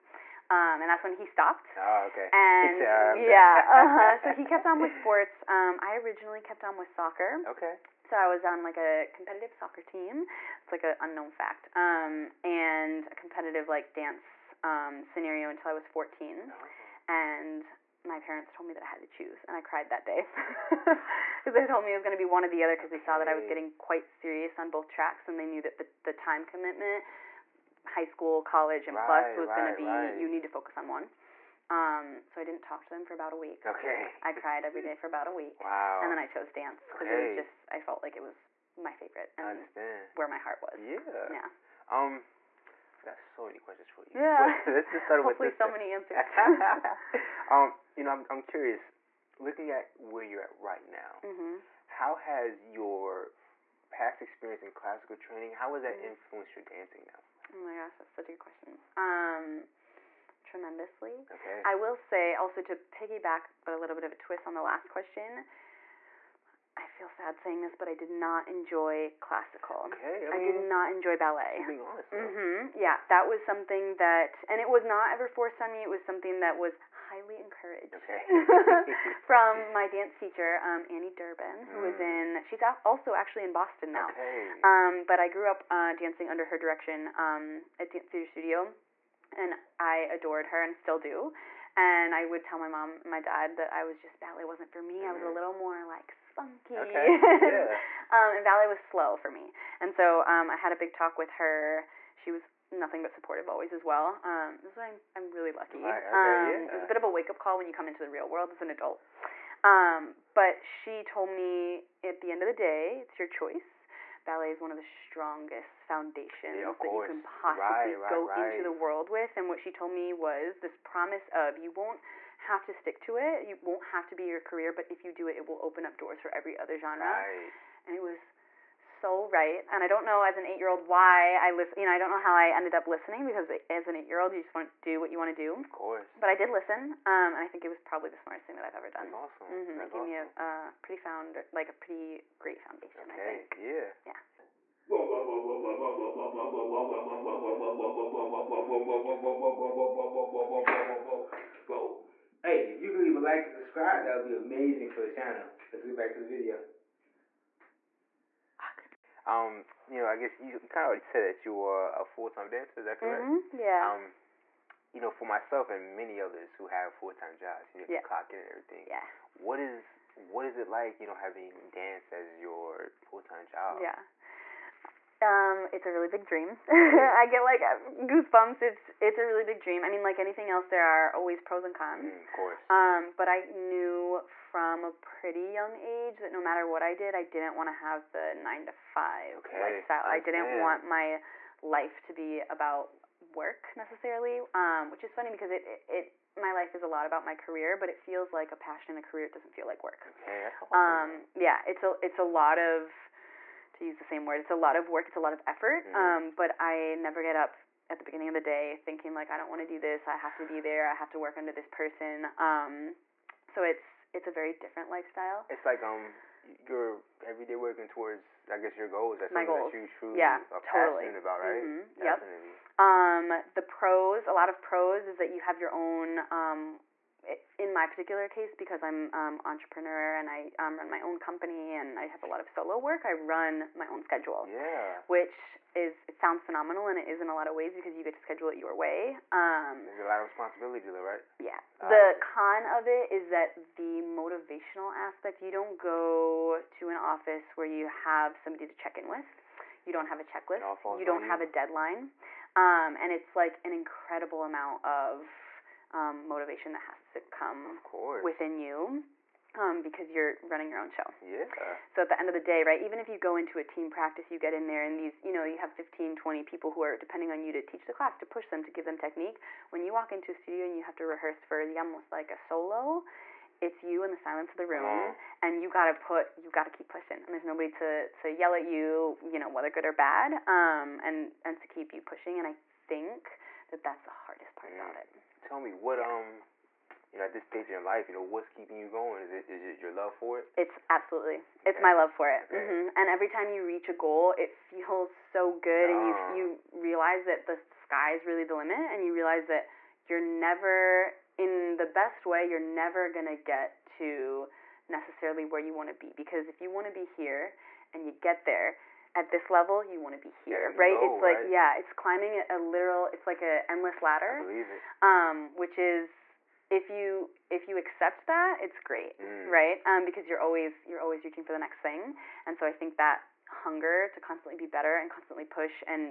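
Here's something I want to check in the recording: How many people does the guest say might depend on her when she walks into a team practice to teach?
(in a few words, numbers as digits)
15 to 20.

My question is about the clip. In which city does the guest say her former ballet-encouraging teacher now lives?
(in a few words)
Boston.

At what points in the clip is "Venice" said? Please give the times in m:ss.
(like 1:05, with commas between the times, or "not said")
not said.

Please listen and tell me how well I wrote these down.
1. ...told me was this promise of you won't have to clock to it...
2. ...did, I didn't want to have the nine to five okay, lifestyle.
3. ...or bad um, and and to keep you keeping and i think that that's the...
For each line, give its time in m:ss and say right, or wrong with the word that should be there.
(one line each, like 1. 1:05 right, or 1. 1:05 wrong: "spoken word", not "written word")
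1. 1:59 wrong: "stick", not "clock"
2. 3:06 right
3. 4:39 wrong: "pushing", not "keeping".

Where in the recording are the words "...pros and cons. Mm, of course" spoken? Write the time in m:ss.
3:01.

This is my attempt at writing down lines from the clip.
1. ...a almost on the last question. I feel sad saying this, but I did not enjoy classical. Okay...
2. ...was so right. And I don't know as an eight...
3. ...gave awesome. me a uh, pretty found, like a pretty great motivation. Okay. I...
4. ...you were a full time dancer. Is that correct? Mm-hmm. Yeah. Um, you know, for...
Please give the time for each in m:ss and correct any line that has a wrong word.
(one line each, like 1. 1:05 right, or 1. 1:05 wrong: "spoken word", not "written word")
1. 1:04 wrong: "twist", not "almost"
2. 2:08 right
3. 2:19 wrong: "foundation", not "motivation"
4. 2:41 right.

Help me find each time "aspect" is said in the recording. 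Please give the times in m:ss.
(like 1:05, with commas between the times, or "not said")
4:04.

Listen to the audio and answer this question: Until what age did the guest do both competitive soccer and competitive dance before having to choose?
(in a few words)
14.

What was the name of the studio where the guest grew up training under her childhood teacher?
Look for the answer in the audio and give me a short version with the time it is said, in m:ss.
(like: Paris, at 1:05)
Dance Theater Studio, at 1:27.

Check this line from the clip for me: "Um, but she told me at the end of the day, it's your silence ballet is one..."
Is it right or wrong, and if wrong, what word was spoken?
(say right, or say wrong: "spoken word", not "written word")
wrong: "choice", not "silence".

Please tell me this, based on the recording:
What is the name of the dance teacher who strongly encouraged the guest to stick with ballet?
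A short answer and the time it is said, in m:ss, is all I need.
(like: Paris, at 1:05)
Annie Durbin, at 1:20.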